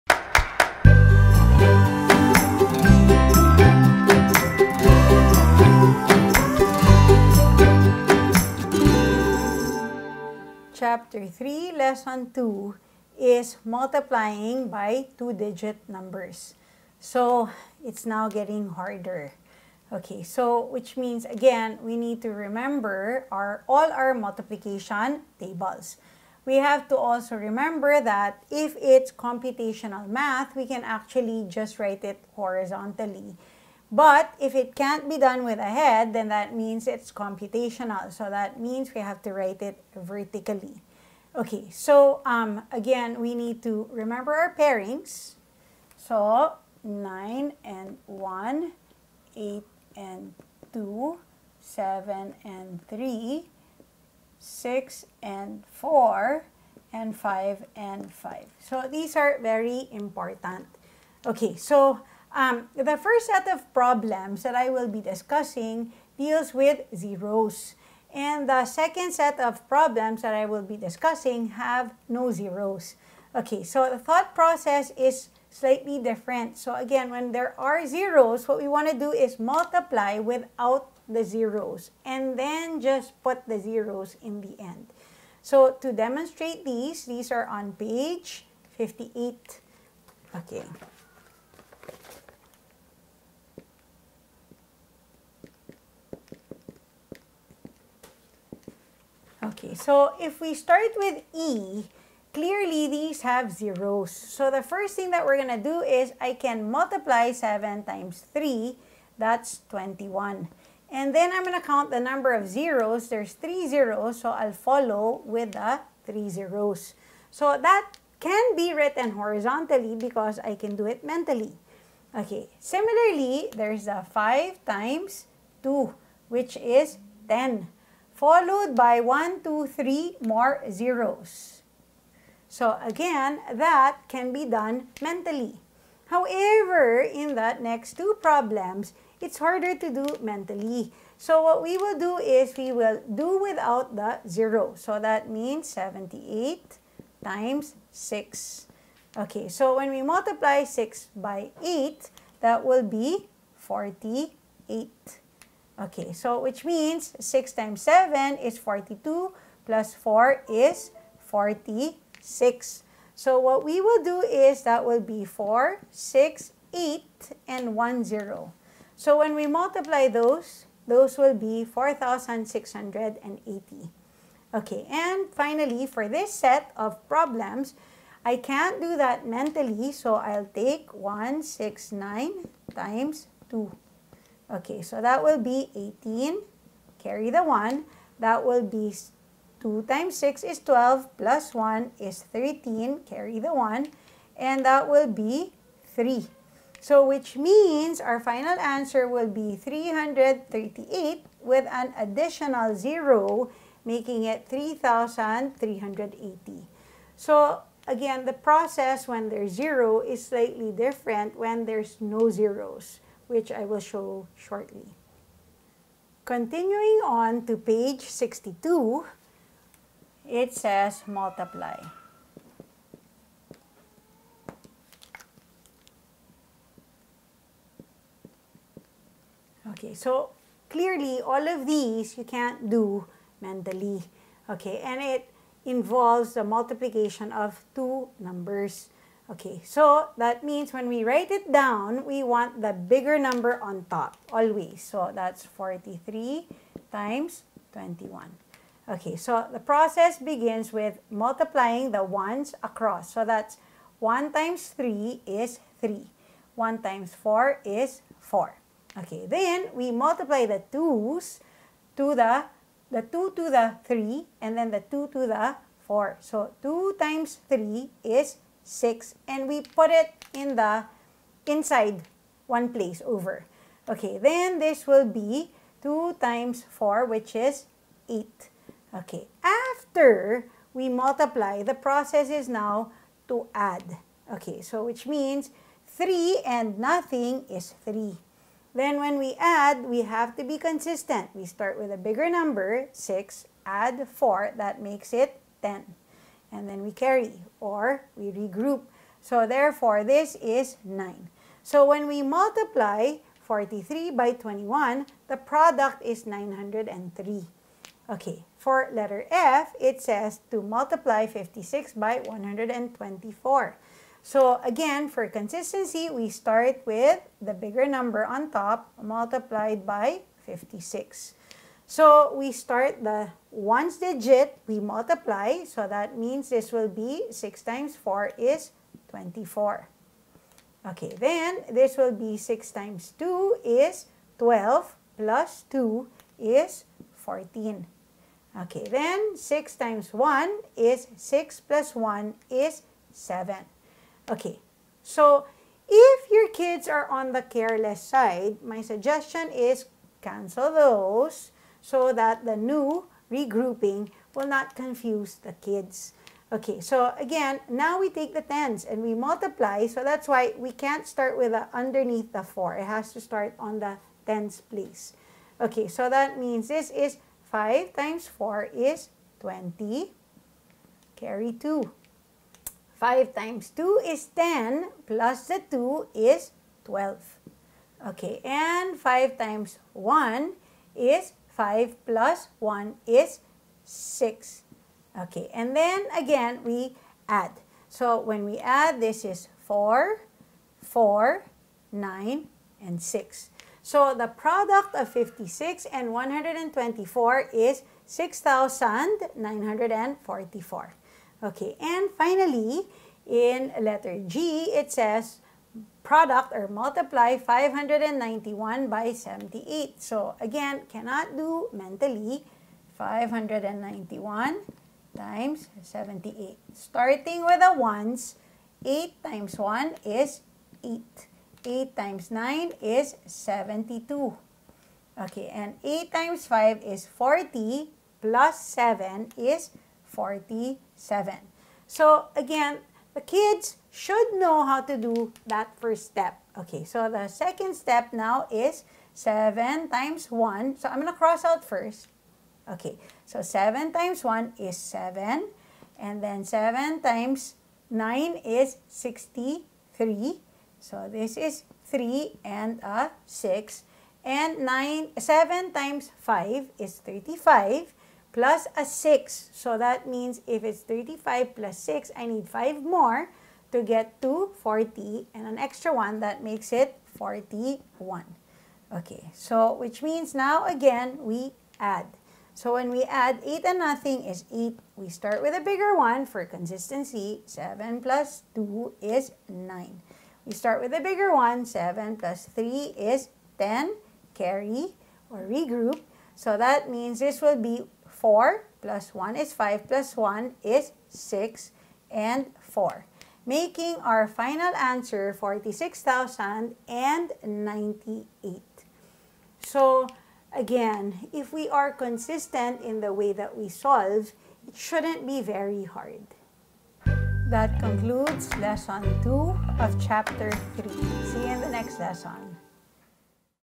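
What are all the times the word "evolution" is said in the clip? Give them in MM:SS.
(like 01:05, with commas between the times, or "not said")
not said.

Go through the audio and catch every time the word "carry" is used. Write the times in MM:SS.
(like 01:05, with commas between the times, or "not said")
03:06, 03:13, 04:56, 06:11, 08:04.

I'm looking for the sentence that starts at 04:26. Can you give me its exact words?
So 2 times 3 is 6, and we put it in the inside one place over.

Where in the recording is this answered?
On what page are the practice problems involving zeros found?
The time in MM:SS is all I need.
01:28.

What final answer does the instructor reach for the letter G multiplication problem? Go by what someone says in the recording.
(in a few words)
46,098.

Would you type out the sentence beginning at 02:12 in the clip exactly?
So again, that can be done mentally.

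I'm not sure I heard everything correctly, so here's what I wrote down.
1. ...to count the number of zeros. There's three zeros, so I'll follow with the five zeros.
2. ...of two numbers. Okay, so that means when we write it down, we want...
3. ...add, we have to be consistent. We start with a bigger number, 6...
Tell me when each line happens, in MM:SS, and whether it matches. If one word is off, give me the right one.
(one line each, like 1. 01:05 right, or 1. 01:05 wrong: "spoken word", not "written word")
1. 01:51 wrong: "three", not "five"
2. 03:57 right
3. 04:49 right.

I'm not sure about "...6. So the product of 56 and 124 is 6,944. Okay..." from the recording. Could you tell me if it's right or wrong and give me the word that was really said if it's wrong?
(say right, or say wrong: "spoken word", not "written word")
right.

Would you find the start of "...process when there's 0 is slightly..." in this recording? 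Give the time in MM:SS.
03:28.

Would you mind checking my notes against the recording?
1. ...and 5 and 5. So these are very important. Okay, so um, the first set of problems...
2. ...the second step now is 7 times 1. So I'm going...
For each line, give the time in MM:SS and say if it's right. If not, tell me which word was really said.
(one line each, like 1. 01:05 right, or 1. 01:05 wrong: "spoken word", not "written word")
1. 00:56 right
2. 07:17 right.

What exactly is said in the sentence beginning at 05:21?
So we start the ones digit, we multiply, so that means this will be 6 times 4 is 24.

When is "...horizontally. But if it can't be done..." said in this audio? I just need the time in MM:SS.
00:32.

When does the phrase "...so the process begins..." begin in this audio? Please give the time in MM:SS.
04:09.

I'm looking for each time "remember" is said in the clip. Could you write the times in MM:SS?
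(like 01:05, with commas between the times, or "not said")
00:22, 00:27, 00:43.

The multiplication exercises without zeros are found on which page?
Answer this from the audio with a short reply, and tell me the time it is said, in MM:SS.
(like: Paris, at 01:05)
62, at 03:37.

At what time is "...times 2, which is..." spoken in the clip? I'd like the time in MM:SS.
02:04.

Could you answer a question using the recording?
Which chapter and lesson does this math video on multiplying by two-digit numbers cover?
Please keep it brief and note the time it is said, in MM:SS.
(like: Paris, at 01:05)
Chapter 3, lesson 2, at 00:10.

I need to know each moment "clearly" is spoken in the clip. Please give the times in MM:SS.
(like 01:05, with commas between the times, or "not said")
01:42, 03:50.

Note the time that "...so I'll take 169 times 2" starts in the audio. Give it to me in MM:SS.
02:59.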